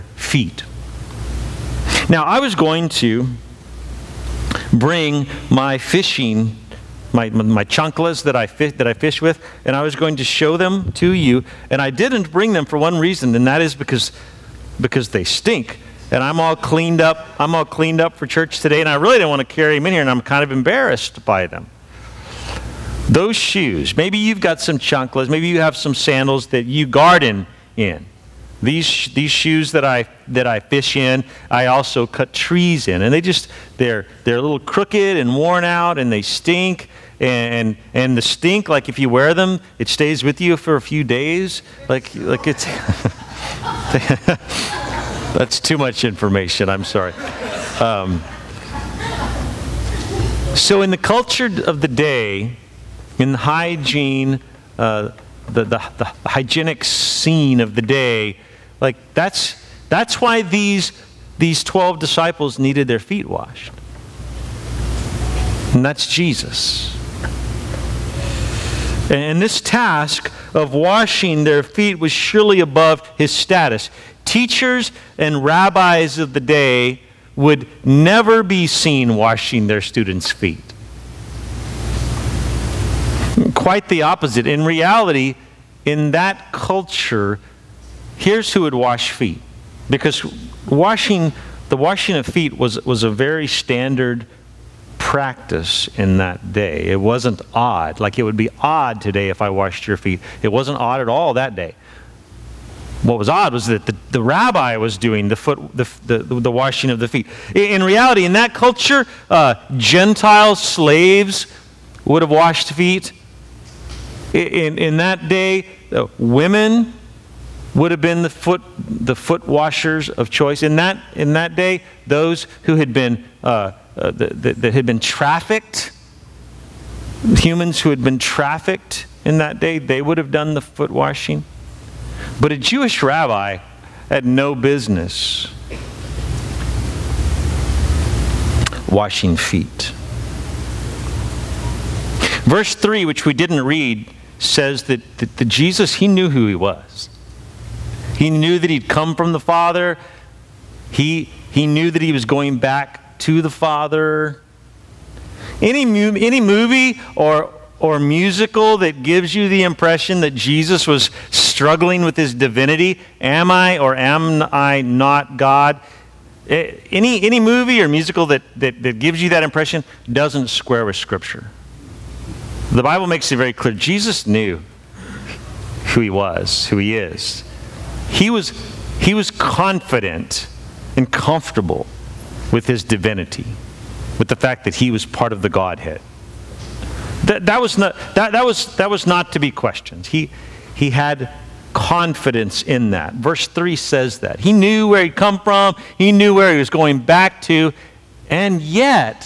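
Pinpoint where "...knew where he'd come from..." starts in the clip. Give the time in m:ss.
3:14.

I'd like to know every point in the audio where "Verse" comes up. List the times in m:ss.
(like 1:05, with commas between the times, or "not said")
2:22, 3:13.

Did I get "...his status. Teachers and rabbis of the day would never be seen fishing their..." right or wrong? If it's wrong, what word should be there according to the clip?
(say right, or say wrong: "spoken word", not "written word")
wrong: "washing", not "fishing".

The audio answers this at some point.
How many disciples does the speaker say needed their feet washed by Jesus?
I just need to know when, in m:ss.
1:01.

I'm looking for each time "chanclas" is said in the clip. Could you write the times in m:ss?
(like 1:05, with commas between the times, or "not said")
0:07, 0:24.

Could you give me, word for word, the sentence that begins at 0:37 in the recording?
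And, and the stink, like if you wear them, it stays with you for a few days.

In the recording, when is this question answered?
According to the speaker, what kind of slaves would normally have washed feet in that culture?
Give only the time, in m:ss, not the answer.
1:49.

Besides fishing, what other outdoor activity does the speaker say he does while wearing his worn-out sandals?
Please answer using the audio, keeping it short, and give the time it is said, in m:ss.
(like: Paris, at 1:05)
cut trees, at 0:32.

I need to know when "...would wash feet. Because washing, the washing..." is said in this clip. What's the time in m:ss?
1:28.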